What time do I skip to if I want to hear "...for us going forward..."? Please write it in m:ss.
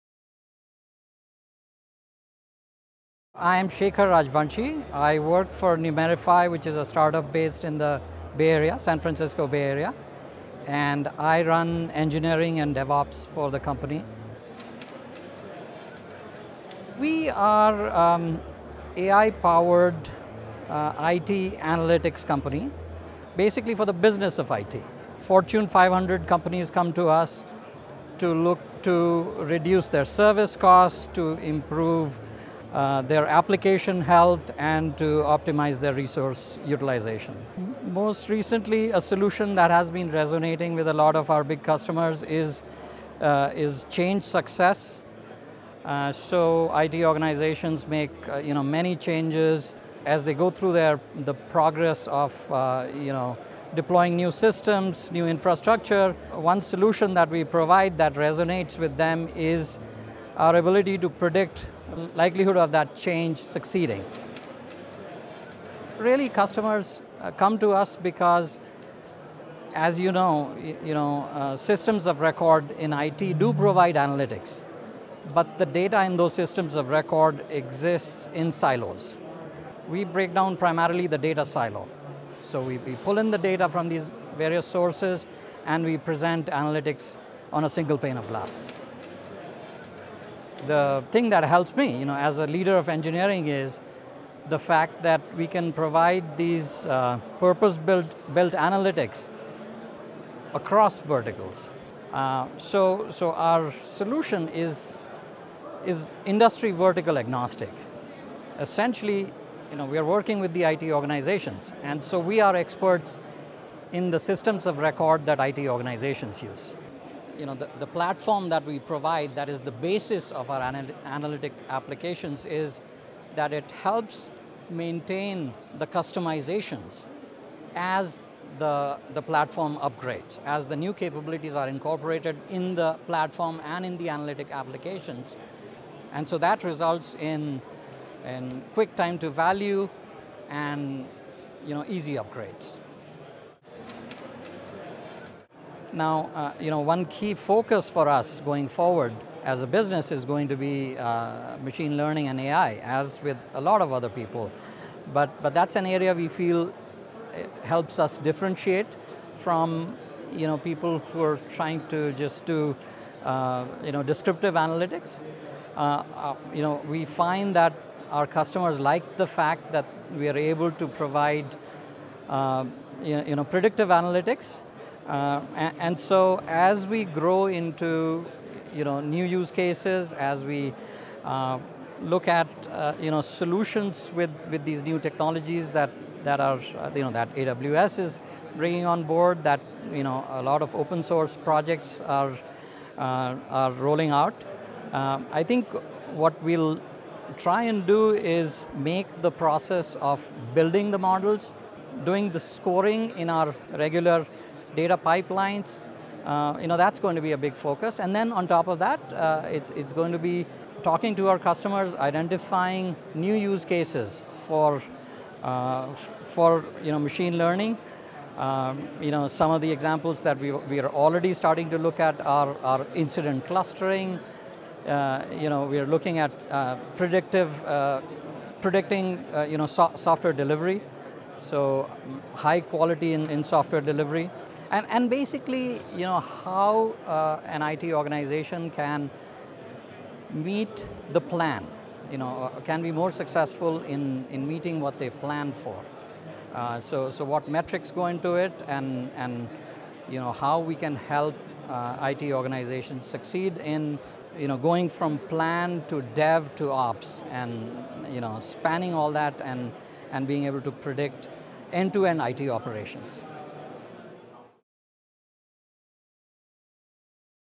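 2:27.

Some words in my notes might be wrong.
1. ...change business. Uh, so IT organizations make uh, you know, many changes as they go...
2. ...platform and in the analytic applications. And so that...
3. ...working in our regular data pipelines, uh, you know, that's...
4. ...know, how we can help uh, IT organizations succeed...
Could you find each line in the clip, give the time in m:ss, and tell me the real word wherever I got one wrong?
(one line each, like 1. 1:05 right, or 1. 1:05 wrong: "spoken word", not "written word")
1. 0:43 wrong: "success", not "business"
2. 2:13 right
3. 3:22 wrong: "scoring", not "working"
4. 4:10 right.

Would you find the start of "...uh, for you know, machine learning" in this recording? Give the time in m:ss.
3:35.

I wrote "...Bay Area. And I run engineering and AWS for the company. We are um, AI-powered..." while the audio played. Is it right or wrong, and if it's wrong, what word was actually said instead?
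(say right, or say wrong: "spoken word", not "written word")
wrong: "DevOps", not "AWS".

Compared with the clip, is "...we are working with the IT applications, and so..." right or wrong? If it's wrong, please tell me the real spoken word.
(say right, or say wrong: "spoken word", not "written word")
wrong: "organizations", not "applications".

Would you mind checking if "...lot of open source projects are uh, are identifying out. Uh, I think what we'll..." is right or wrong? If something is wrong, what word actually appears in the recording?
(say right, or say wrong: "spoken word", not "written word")
wrong: "rolling", not "identifying".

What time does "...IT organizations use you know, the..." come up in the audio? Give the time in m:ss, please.
1:55.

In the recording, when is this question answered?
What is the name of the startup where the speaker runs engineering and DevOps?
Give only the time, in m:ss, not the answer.
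0:05.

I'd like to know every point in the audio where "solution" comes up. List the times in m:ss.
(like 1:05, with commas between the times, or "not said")
0:39, 0:56, 1:43, 3:03.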